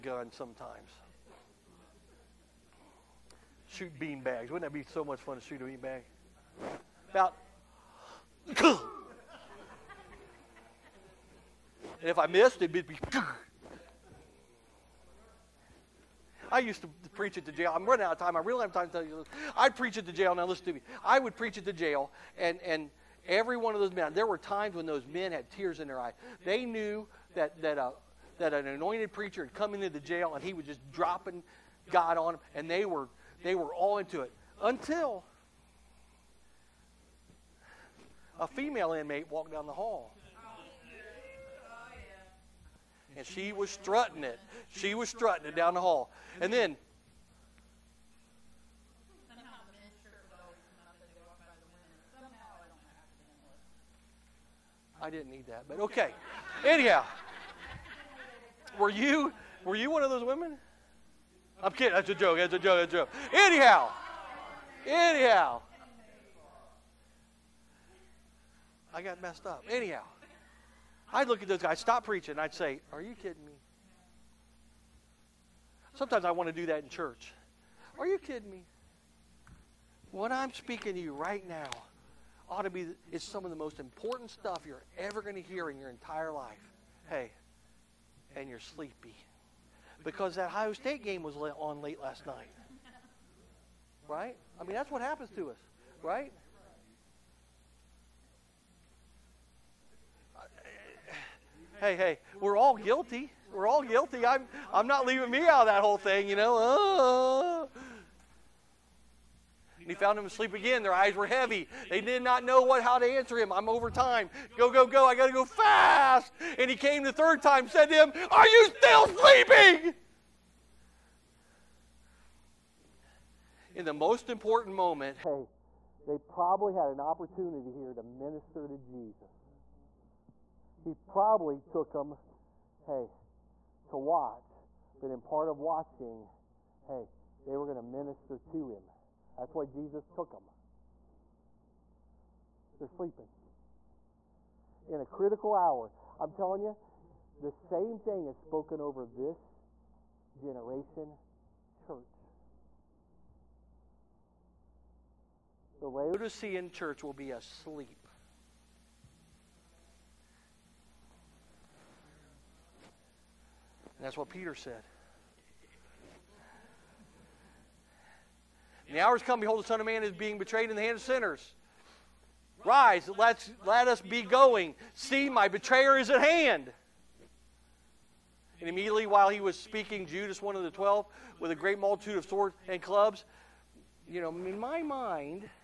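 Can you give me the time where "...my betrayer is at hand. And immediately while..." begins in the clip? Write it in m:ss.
2:55.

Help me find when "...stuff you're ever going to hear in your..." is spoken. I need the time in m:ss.
1:24.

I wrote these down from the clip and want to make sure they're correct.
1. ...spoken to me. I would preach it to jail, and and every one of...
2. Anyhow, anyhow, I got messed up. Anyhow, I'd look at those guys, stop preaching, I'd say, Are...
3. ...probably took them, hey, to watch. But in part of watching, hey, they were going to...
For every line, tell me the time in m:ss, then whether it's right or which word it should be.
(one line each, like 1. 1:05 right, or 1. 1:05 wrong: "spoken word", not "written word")
1. 0:20 wrong: "listen", not "spoken"
2. 1:03 right
3. 2:10 right.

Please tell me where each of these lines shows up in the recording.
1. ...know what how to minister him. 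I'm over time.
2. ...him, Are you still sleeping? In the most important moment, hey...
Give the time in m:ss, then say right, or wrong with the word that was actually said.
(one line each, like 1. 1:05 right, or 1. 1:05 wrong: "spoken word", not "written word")
1. 1:52 wrong: "answer", not "minister"
2. 1:57 right.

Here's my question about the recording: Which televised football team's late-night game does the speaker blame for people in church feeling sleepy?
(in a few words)
Ohio State.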